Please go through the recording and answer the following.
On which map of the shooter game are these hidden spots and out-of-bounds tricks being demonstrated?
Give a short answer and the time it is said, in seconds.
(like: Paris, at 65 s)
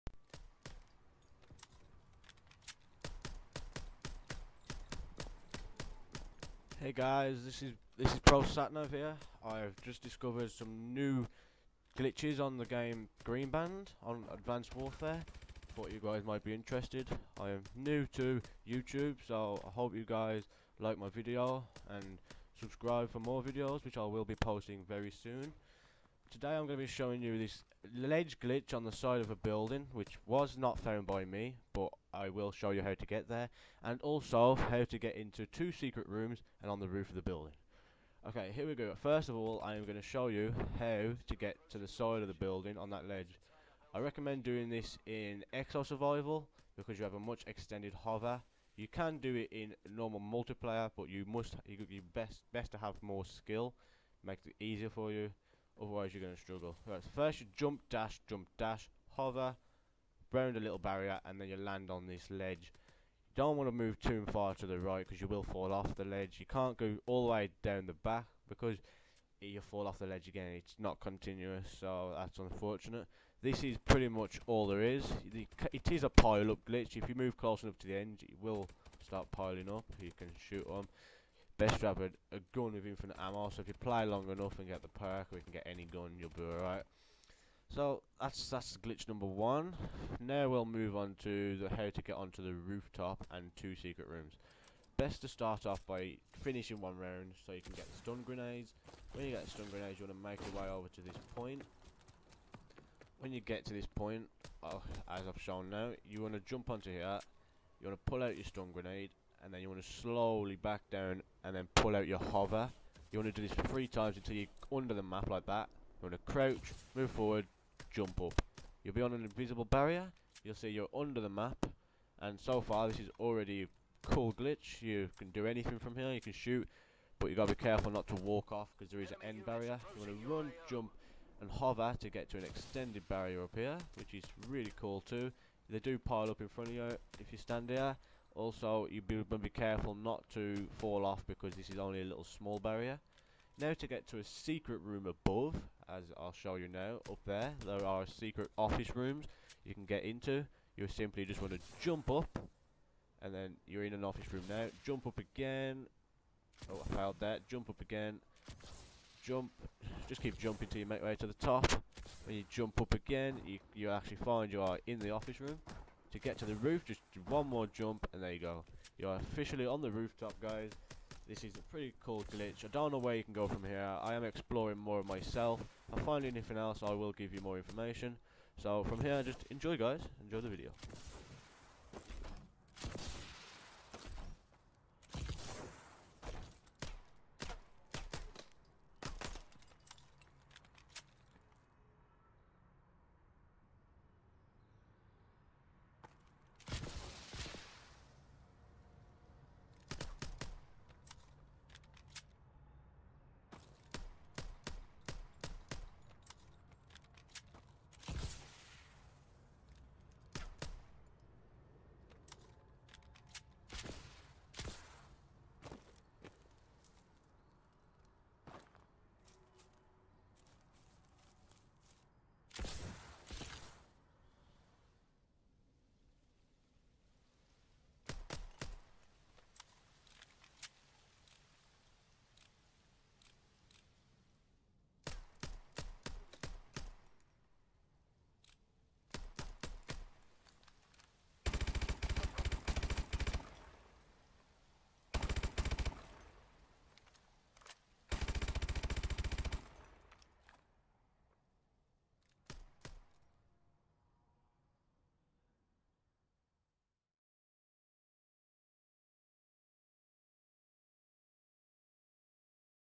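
Greenband, at 13 s.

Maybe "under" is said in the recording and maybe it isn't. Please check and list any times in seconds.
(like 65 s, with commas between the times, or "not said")
114 s, 120 s.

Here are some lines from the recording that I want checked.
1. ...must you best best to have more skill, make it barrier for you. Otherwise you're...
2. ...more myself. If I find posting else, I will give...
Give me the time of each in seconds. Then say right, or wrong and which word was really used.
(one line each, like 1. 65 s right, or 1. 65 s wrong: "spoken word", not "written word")
1. 51 s wrong: "easier", not "barrier"
2. 174 s wrong: "anything", not "posting".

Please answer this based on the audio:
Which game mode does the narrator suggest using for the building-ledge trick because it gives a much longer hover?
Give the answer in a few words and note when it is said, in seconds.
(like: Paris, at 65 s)
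Exo Survival, at 45 s.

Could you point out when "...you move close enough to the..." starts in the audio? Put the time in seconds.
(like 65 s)
77 s.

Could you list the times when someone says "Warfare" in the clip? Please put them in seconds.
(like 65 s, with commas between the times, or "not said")
14 s.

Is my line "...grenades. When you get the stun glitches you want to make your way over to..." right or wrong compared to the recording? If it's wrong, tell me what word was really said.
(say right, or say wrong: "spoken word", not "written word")
wrong: "grenades", not "glitches".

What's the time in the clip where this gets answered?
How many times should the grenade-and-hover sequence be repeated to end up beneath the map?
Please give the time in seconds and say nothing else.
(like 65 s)
113 s.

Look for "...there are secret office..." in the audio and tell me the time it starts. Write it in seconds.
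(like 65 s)
147 s.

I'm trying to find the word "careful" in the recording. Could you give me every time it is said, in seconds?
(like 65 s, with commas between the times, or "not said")
127 s, 139 s.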